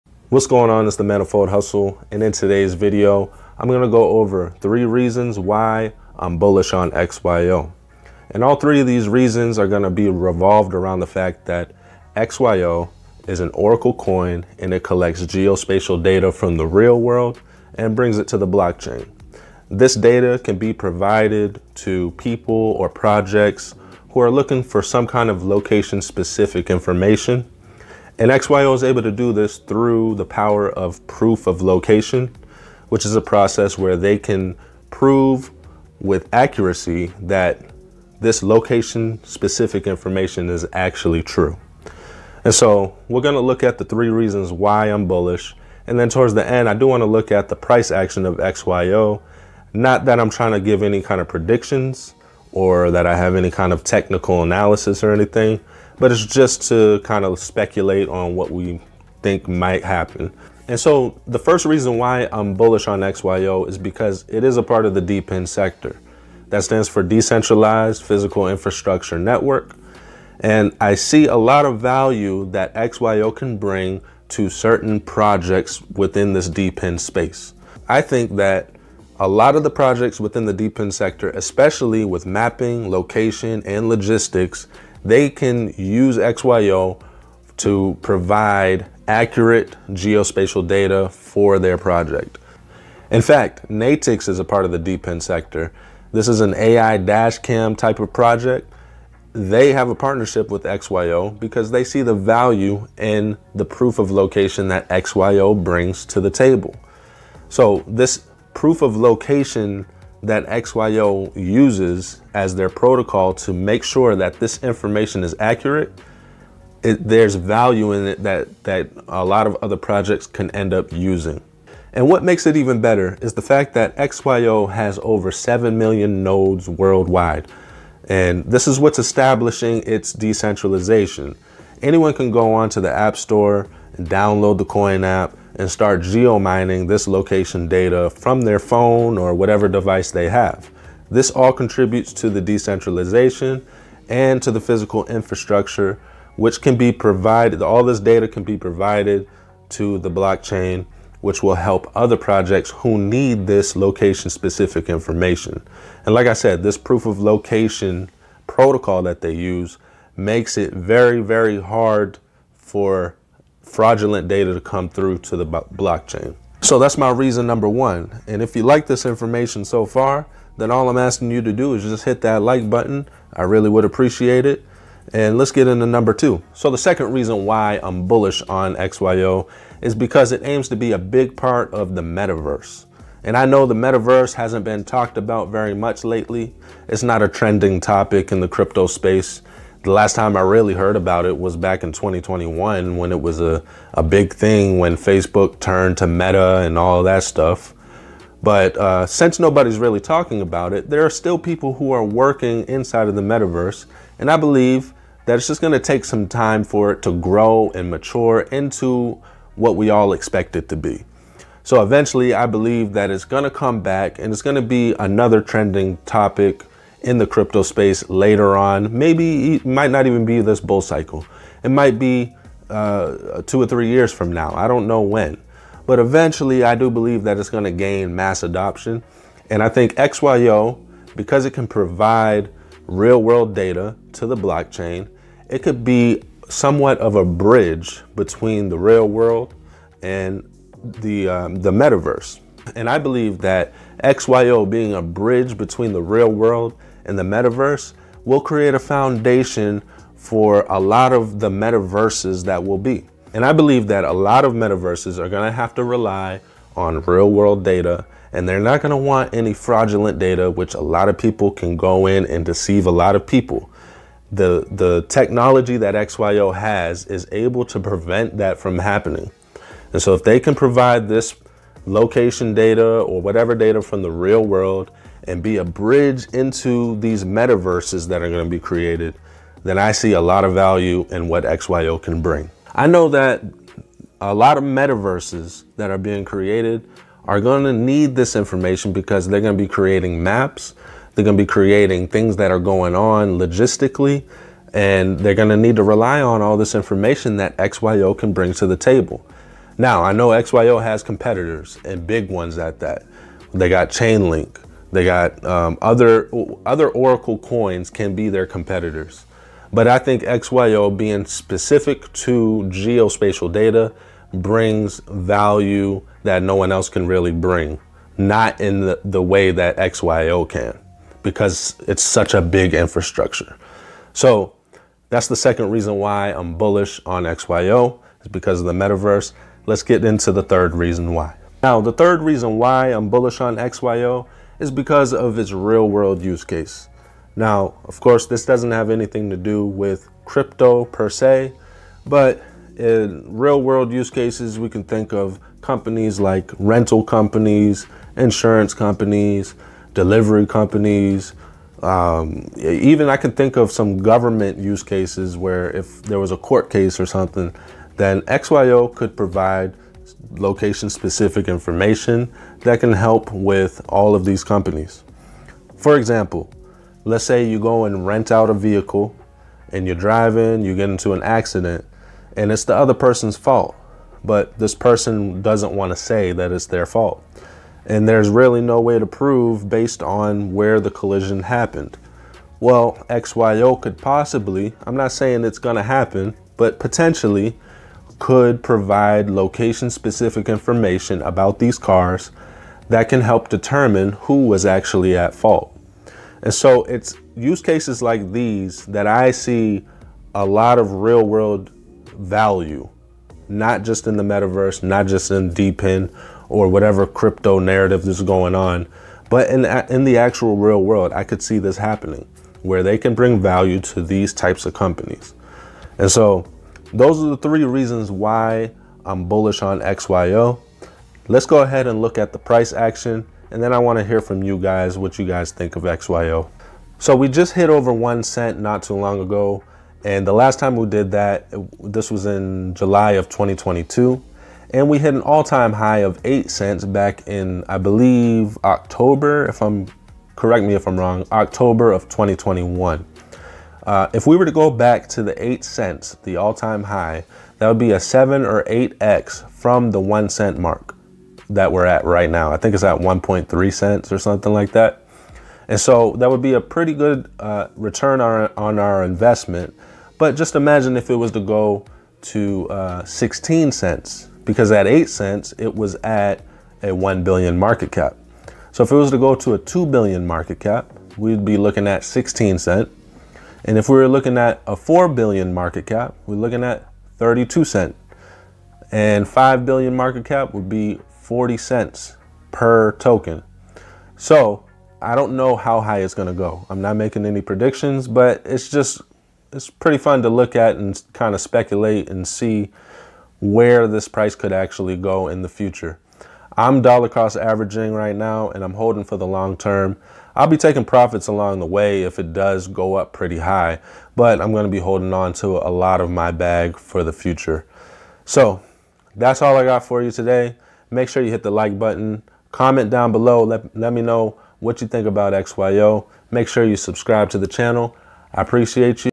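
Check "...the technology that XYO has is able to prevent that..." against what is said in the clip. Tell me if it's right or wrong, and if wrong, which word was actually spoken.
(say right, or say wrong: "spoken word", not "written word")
right.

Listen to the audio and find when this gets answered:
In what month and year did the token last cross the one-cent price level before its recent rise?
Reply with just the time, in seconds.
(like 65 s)
432 s.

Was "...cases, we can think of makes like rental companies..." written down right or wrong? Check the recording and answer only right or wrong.
wrong.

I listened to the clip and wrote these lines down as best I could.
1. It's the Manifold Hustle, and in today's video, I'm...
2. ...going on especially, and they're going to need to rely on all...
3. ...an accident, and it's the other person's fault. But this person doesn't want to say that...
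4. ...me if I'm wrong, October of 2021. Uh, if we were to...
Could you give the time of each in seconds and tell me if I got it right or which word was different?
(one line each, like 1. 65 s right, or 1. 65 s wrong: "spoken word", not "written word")
1. 0 s right
2. 292 s wrong: "logistically", not "especially"
3. 371 s right
4. 440 s right.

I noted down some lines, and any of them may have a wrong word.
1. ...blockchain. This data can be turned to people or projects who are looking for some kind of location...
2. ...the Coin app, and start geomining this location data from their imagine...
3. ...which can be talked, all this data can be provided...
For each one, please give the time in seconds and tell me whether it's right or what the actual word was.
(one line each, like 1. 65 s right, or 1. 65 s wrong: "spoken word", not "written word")
1. 18 s wrong: "provided", not "turned"
2. 134 s wrong: "phone", not "imagine"
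3. 146 s wrong: "provided", not "talked".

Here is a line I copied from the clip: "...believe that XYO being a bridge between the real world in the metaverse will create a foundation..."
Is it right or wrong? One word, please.
right.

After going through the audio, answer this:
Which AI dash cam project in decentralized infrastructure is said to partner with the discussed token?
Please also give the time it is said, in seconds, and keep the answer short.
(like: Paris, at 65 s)
Natix, at 93 s.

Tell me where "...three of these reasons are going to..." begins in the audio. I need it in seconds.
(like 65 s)
8 s.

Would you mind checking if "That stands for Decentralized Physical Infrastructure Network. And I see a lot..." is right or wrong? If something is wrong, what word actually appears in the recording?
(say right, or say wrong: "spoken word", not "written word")
right.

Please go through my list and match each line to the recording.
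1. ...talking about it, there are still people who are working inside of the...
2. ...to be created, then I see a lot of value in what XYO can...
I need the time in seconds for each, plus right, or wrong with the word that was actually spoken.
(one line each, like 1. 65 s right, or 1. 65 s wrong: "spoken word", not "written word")
1. 199 s right
2. 278 s right.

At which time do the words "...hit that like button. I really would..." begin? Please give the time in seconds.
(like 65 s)
172 s.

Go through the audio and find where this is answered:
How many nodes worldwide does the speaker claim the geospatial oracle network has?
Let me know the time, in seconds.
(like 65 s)
125 s.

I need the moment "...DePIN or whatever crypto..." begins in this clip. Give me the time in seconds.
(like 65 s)
405 s.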